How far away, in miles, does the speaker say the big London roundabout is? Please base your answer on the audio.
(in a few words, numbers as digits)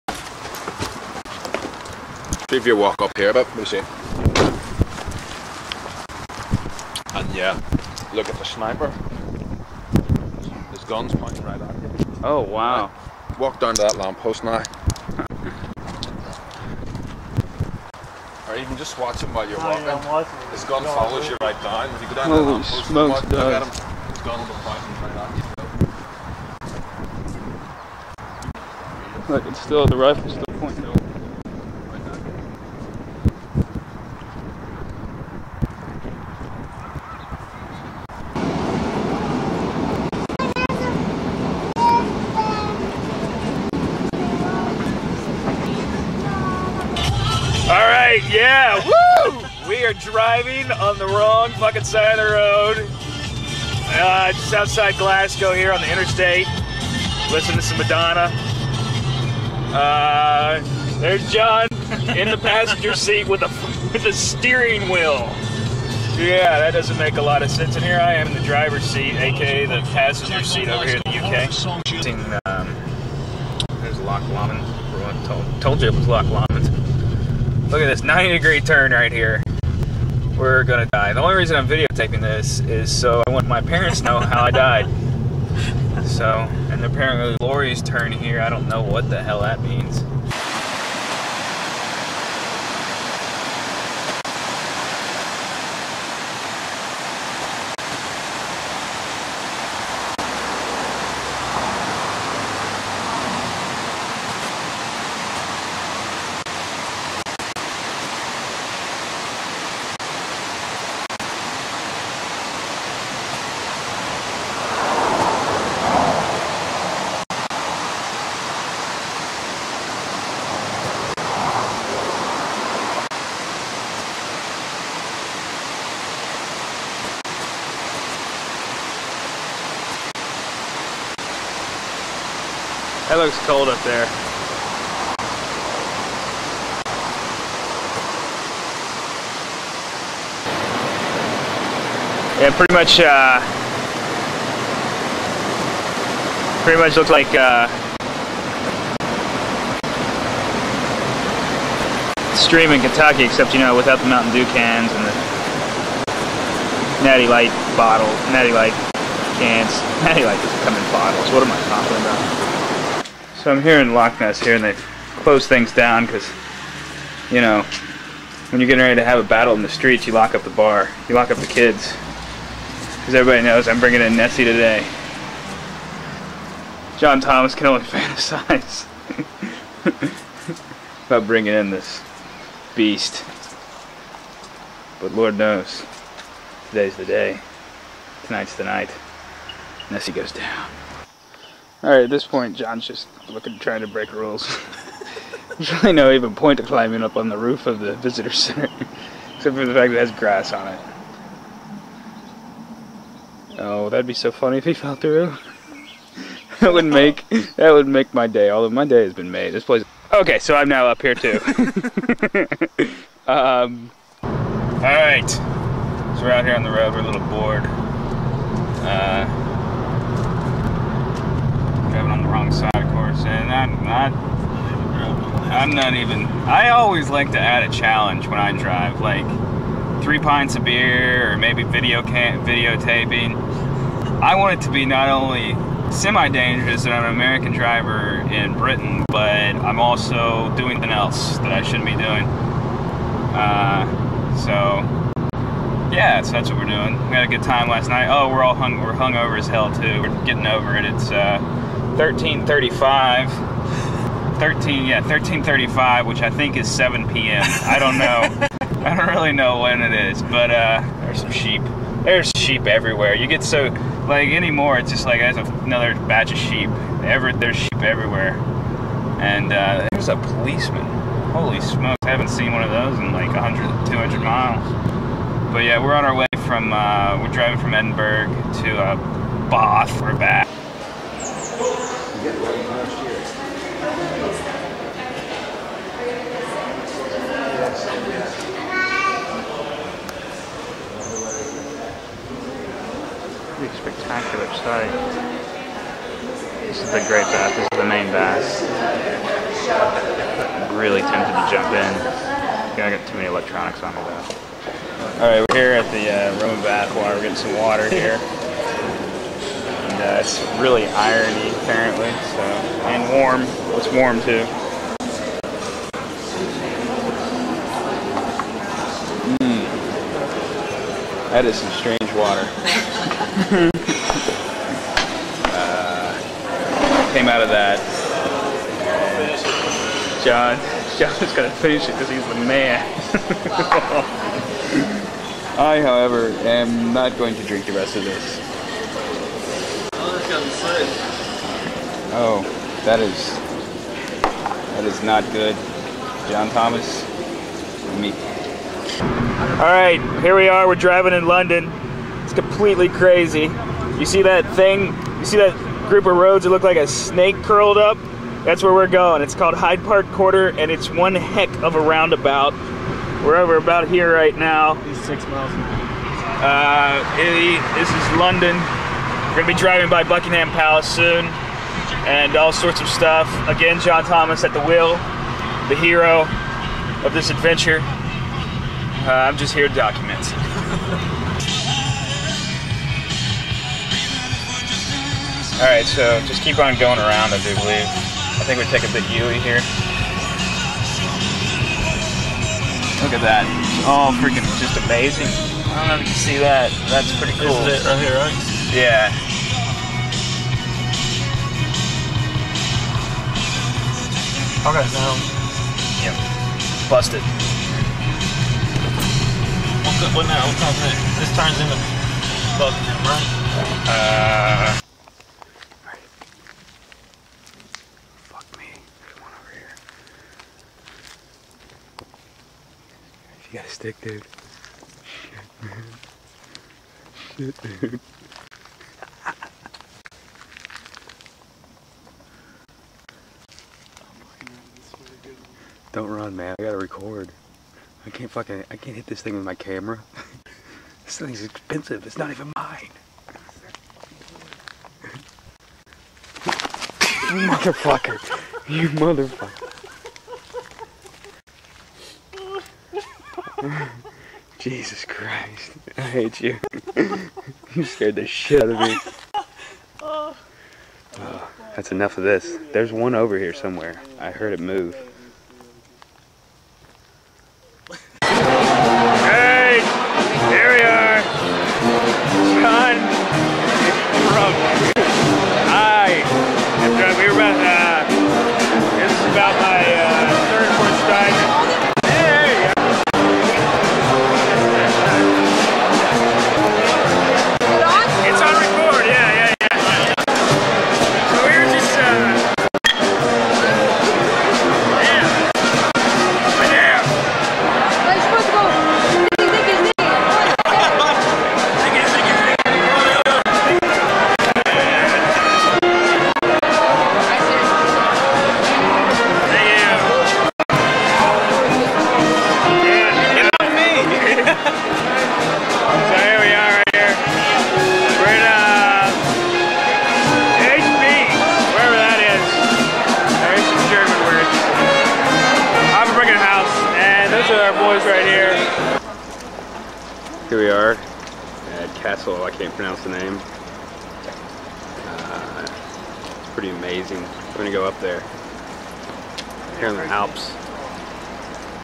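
6 miles.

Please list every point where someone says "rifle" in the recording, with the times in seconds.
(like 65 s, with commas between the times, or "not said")
29 s.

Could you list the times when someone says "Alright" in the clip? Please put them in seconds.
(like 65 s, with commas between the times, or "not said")
191 s, 305 s, 385 s.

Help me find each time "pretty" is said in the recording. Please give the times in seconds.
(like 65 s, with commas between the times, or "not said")
142 s, 146 s, 397 s, 536 s.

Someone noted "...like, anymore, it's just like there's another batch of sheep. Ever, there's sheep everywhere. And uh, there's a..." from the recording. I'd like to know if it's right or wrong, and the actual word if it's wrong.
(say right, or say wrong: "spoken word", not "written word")
right.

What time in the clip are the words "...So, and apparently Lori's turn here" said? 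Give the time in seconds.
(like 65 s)
86 s.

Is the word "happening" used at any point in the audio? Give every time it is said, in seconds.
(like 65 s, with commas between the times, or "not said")
not said.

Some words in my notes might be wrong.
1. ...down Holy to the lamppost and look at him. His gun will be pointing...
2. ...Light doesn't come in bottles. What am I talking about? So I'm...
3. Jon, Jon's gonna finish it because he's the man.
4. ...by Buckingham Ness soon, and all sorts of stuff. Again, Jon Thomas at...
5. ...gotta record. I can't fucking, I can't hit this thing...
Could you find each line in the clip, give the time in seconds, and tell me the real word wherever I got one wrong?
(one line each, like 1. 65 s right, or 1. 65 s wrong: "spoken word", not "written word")
1. 22 s right
2. 160 s right
3. 330 s right
4. 369 s wrong: "Palace", not "Ness"
5. 436 s right.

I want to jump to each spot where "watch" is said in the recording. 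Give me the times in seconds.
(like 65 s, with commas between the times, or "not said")
18 s.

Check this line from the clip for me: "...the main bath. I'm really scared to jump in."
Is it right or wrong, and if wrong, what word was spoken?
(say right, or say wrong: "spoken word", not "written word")
wrong: "tempted", not "scared".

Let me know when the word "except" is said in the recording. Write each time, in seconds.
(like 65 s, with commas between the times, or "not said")
153 s, 199 s.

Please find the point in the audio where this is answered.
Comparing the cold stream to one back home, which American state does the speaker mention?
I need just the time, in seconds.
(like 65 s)
152 s.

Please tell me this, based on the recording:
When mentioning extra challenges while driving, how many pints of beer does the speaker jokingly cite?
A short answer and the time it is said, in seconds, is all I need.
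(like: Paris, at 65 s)
3, at 230 s.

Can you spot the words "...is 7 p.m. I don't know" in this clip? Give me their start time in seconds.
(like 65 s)
256 s.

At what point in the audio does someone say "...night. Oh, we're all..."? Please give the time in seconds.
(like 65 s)
247 s.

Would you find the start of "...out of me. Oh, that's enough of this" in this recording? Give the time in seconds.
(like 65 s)
458 s.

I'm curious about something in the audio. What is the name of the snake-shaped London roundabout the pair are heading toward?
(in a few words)
Hyde Park Corner.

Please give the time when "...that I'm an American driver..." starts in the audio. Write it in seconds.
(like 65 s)
236 s.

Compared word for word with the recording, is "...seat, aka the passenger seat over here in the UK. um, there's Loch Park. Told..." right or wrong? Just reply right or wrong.
wrong.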